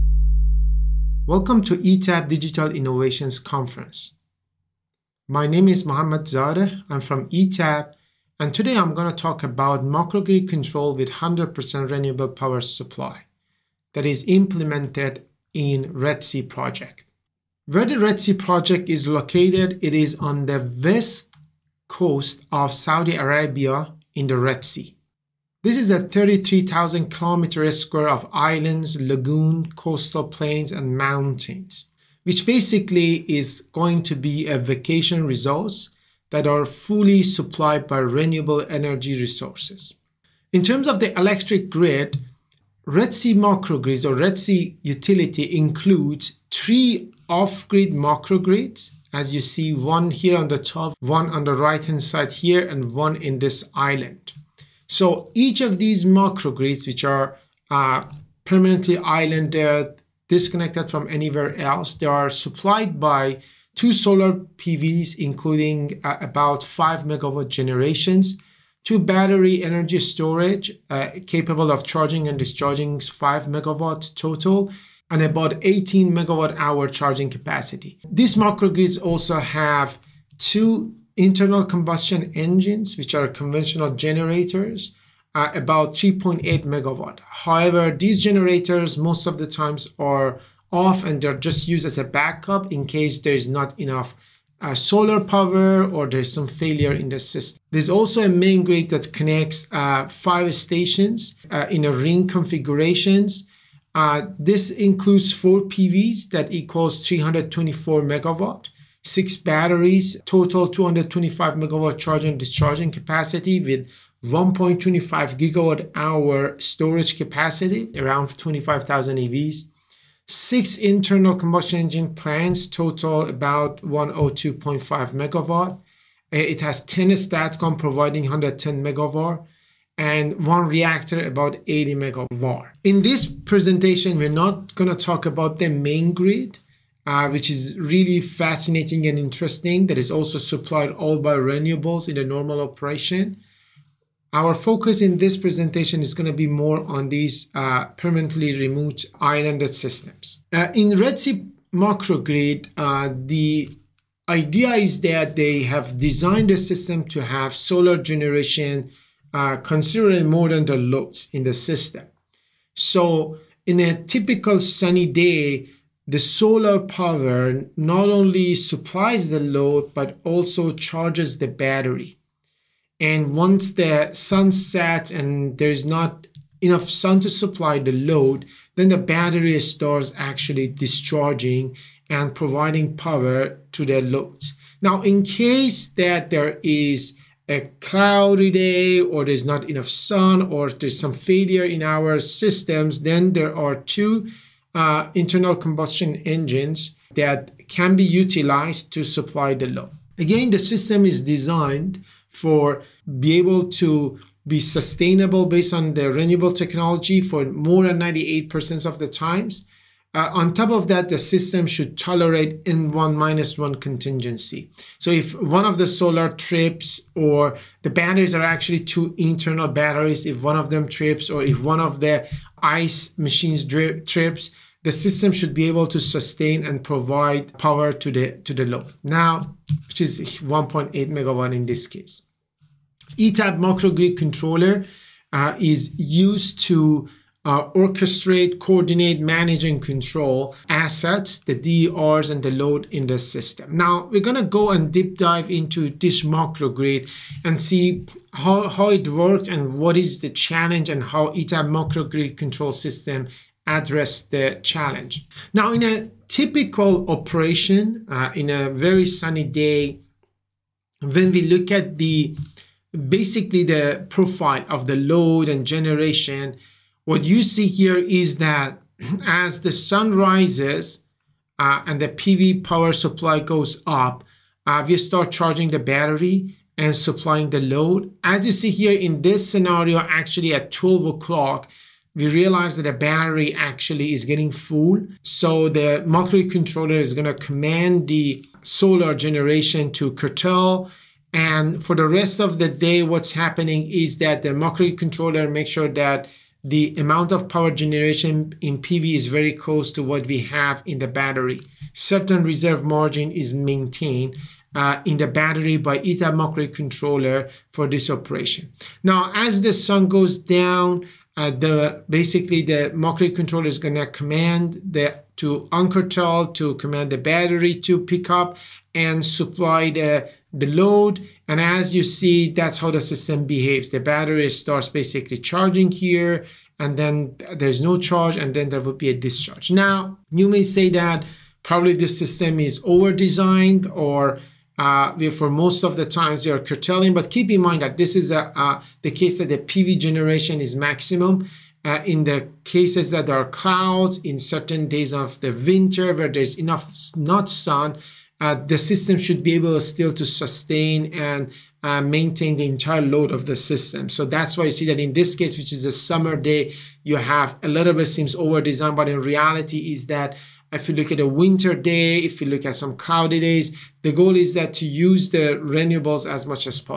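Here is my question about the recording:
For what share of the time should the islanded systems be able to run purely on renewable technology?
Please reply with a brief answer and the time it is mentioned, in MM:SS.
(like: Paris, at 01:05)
more than 98%, at 03:27.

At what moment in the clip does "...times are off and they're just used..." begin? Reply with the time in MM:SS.
01:29.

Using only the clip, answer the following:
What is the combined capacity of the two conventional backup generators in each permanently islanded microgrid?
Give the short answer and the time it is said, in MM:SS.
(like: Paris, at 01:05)
3.8 megawatt, at 01:25.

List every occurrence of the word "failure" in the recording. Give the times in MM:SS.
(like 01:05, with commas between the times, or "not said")
01:36, 03:11.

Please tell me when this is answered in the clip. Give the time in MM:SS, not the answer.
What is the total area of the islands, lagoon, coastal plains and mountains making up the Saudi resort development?
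00:26.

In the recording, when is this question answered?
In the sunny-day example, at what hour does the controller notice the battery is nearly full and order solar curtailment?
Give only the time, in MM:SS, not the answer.
04:40.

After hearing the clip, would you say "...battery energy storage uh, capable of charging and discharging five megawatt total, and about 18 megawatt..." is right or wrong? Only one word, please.
right.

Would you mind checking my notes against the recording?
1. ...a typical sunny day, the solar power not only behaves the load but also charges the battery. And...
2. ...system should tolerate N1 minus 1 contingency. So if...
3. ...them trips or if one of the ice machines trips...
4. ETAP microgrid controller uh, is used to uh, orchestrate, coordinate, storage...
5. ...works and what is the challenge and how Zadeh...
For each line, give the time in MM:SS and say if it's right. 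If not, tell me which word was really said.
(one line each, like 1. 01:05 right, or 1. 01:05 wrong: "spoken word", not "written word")
1. 02:43 wrong: "supplies", not "behaves"
2. 03:31 right
3. 03:40 right
4. 03:53 wrong: "manage", not "storage"
5. 04:09 wrong: "ETAP", not "Zadeh".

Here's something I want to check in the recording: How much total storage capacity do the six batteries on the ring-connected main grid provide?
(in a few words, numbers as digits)
1.25 gigawatt hour.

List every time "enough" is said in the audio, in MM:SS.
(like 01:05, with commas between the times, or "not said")
01:33, 02:56, 03:09, 05:46.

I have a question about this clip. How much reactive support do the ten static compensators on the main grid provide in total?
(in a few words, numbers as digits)
110 megawatt.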